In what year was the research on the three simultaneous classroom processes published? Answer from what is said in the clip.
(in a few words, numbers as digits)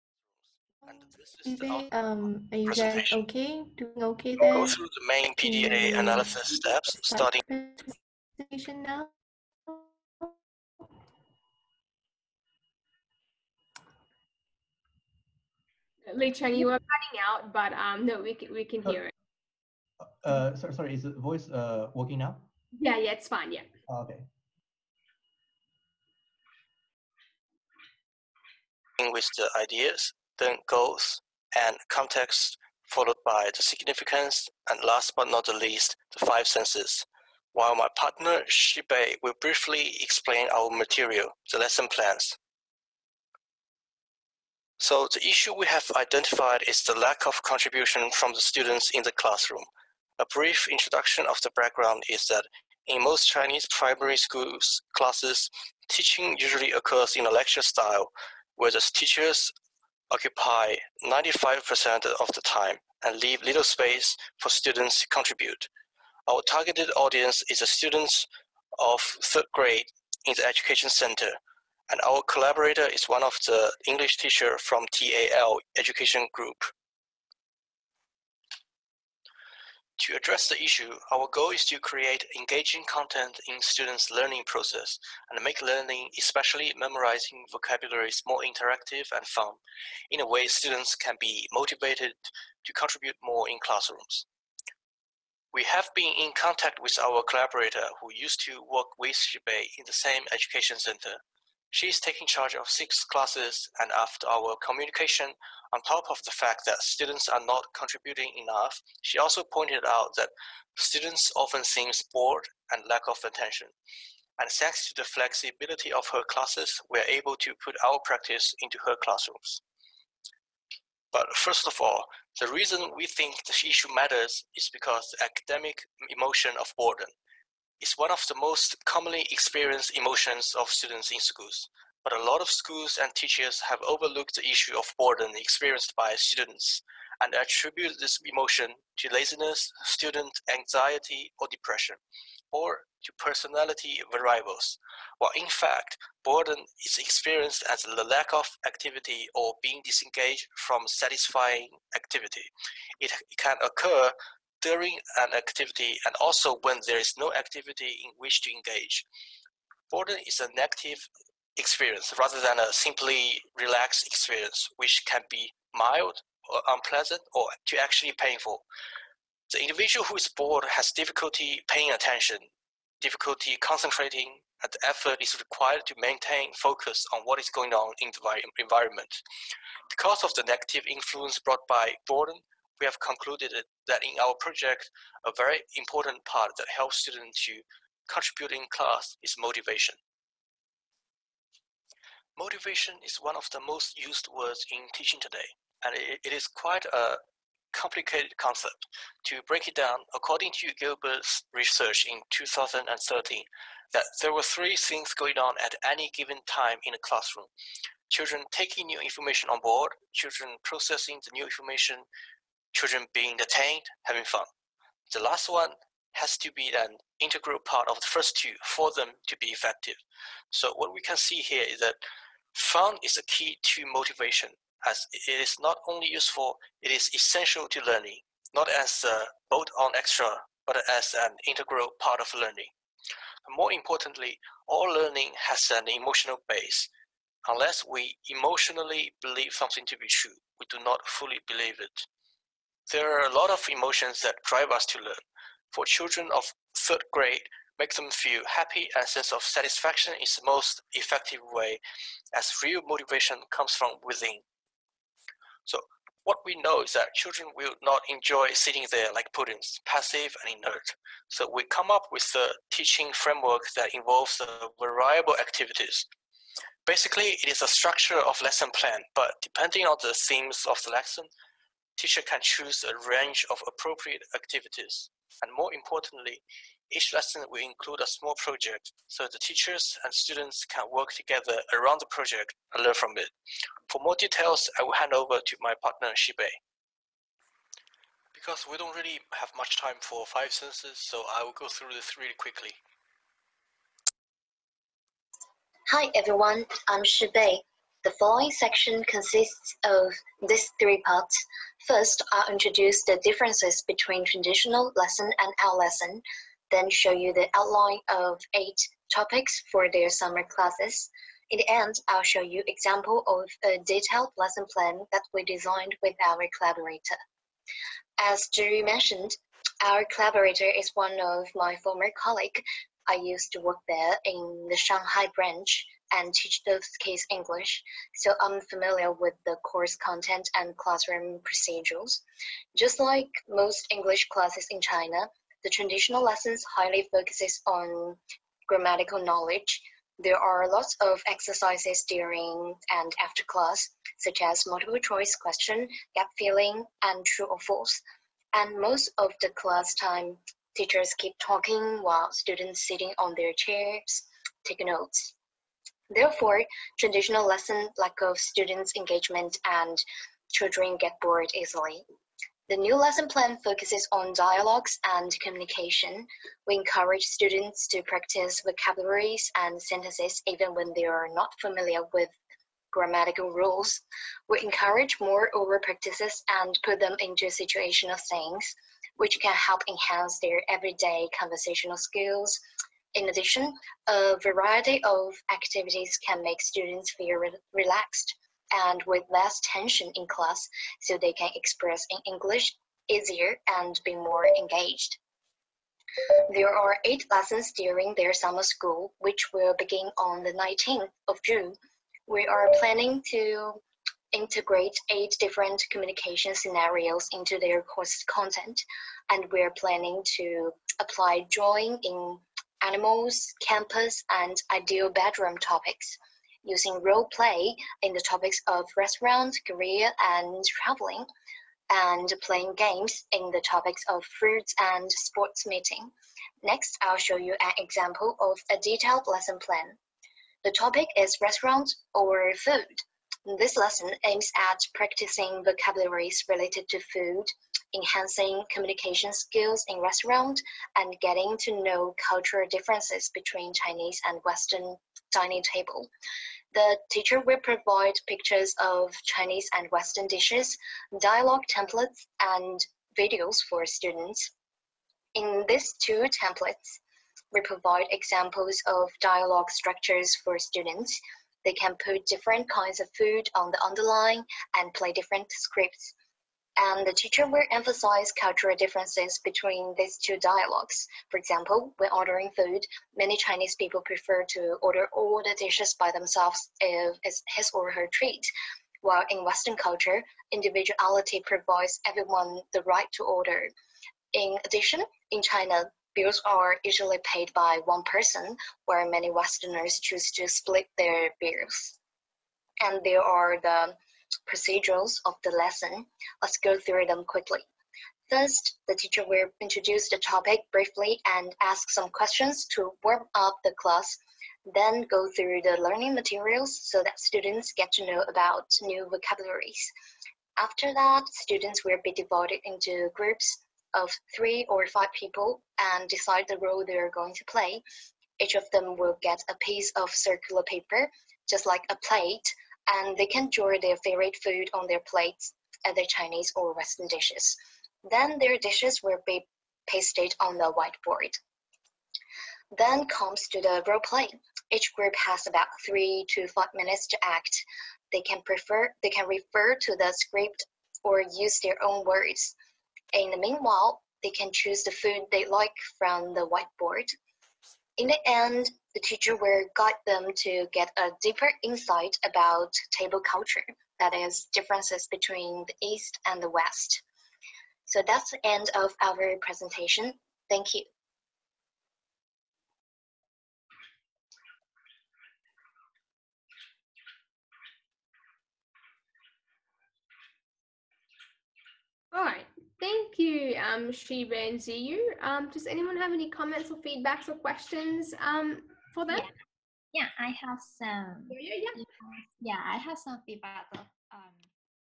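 2013.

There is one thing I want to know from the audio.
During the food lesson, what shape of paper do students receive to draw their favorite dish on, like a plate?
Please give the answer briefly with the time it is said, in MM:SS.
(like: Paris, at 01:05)
circular, at 08:40.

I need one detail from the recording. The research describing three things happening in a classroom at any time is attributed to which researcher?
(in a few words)
Gilbert.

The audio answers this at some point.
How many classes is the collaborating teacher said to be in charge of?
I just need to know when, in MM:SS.
01:42.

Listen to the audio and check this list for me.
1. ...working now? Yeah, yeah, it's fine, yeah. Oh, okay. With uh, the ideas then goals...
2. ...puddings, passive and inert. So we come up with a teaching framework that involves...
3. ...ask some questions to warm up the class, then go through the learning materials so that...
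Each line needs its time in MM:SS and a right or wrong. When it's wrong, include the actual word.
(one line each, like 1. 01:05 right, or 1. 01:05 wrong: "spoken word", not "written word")
1. 00:21 right
2. 04:19 right
3. 08:21 right.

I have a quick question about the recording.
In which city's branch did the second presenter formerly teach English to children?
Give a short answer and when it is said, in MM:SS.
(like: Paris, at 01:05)
Shanghai, at 05:24.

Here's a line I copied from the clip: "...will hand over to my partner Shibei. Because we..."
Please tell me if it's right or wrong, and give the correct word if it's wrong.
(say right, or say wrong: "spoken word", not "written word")
right.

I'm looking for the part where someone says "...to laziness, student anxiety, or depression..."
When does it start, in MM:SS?
02:18.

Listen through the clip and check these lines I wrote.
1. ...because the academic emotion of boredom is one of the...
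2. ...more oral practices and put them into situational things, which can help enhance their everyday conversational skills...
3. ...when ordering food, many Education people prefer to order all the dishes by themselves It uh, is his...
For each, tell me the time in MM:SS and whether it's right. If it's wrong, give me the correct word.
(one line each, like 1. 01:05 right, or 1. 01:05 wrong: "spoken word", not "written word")
1. 02:04 right
2. 06:15 right
3. 07:51 wrong: "Chinese", not "Education".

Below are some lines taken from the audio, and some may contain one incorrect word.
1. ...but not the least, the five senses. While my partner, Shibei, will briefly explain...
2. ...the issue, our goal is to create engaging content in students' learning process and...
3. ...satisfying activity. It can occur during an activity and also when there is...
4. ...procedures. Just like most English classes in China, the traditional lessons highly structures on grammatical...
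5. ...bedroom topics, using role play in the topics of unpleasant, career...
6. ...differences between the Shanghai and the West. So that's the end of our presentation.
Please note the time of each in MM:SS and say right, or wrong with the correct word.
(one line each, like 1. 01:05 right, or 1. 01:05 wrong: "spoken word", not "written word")
1. 00:35 right
2. 01:20 right
3. 02:30 right
4. 05:31 wrong: "focuses", not "structures"
5. 06:55 wrong: "restaurant", not "unpleasant"
6. 09:14 wrong: "East", not "Shanghai".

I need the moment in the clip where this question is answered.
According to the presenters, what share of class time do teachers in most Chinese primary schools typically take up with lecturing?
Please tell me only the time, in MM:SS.
01:01.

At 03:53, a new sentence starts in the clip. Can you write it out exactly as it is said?
More importantly, all learning has an emotional base.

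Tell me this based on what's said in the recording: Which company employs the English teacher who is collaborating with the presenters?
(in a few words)
TAL Education Group.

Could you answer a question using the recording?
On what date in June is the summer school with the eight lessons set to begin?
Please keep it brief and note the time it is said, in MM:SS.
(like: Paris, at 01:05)
19 June, at 06:40.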